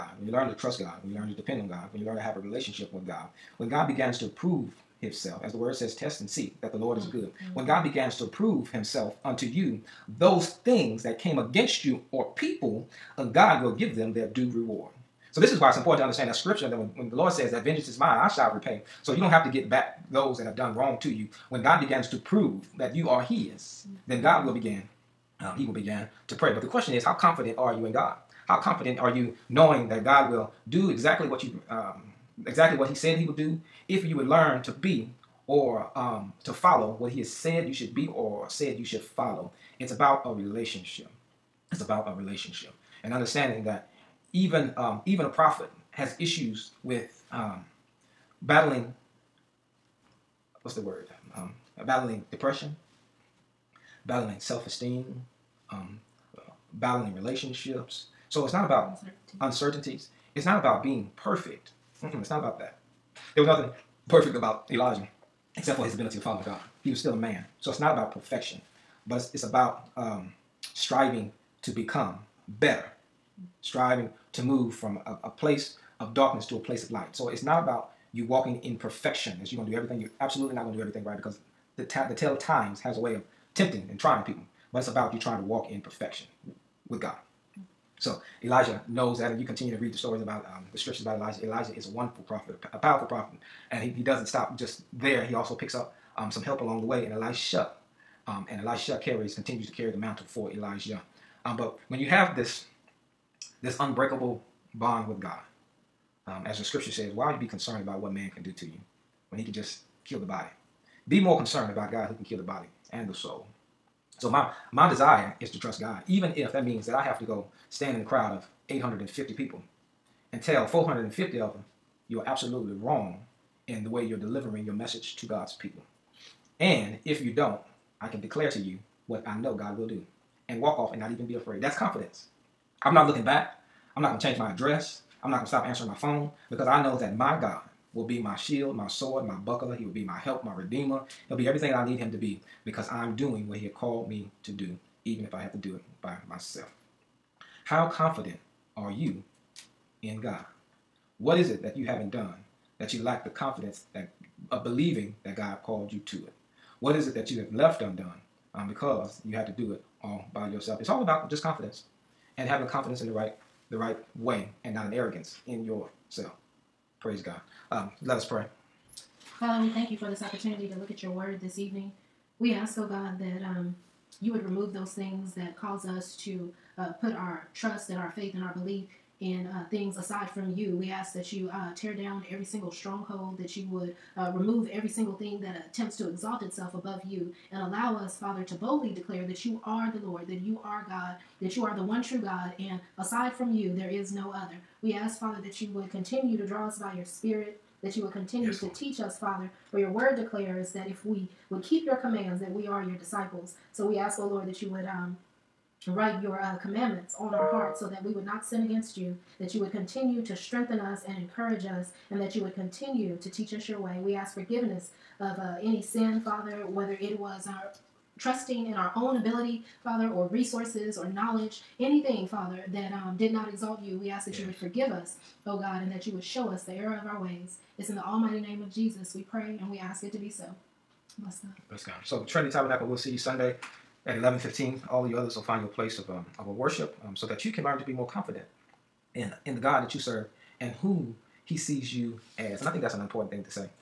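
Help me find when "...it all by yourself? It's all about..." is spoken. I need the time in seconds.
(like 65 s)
159 s.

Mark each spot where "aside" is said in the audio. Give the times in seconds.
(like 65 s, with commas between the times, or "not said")
179 s, 192 s.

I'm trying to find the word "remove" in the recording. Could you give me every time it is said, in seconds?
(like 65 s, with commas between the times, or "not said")
174 s, 184 s.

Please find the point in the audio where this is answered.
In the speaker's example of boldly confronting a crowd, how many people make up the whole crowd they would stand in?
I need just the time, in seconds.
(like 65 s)
118 s.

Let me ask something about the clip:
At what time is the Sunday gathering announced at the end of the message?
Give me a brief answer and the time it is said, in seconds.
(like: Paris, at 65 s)
11:15, at 234 s.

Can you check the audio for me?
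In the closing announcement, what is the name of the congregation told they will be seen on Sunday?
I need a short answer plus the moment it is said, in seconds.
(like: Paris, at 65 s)
Trinity Tabernacle, at 232 s.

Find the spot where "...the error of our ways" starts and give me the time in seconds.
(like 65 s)
226 s.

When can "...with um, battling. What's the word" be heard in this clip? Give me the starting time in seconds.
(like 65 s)
46 s.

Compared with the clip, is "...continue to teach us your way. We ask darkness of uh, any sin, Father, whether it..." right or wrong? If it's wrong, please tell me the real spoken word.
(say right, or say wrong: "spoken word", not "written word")
wrong: "forgiveness", not "darkness".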